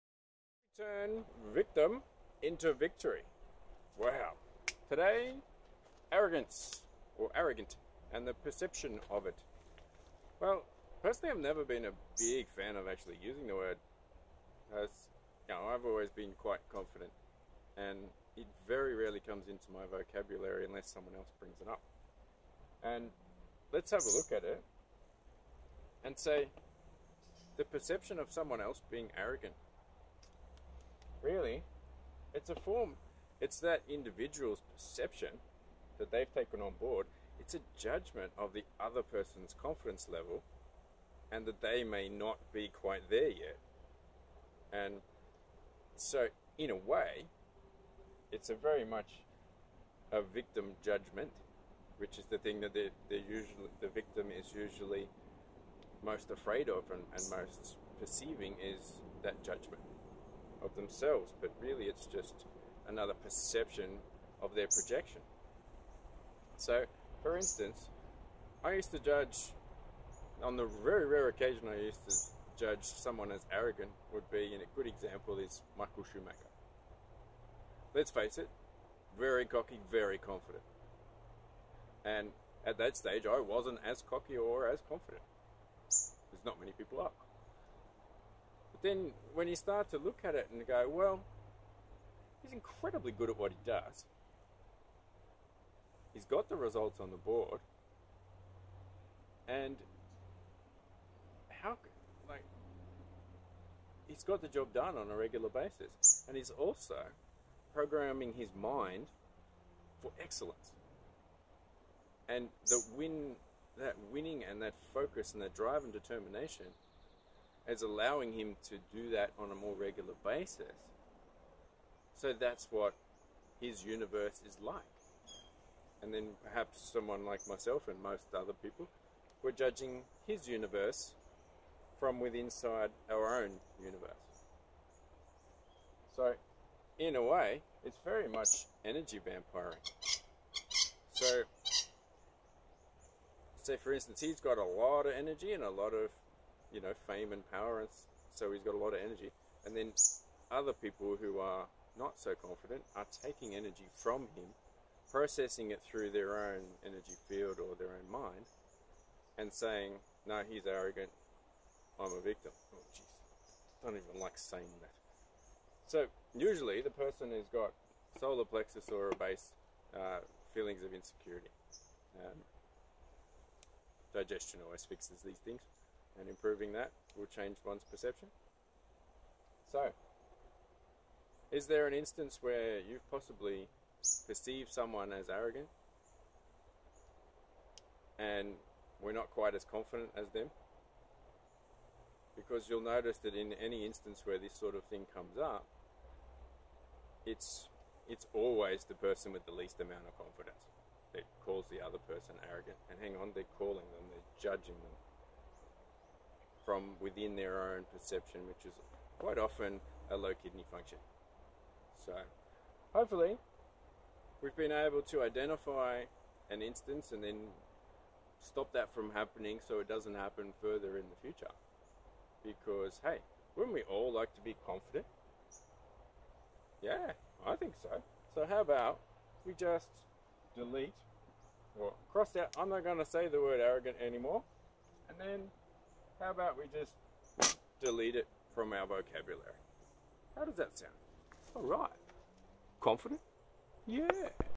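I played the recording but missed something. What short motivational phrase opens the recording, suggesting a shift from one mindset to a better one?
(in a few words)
Turn victim into victory.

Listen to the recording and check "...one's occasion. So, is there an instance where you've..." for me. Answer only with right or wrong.
wrong.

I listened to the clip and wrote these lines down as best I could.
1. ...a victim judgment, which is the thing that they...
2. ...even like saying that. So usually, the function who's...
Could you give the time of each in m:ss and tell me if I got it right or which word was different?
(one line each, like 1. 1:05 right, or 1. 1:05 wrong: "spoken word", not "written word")
1. 0:50 right
2. 2:43 wrong: "person", not "function".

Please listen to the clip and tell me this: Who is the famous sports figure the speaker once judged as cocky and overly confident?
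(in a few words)
Michael Schumacher.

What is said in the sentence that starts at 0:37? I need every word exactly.
It's a judgment of the other person's confidence level and that they may not be quite there yet.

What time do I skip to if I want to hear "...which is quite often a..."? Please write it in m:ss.
3:28.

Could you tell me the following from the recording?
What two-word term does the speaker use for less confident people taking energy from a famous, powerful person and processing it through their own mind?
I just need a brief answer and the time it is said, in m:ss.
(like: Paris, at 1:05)
energy vampiring, at 2:18.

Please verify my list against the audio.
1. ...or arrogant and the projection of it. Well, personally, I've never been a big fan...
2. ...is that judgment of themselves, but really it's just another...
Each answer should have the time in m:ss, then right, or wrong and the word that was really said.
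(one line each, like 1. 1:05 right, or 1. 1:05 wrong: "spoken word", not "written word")
1. 0:07 wrong: "perception", not "projection"
2. 0:58 right.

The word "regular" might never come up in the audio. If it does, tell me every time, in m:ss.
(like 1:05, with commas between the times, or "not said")
1:45, 1:59.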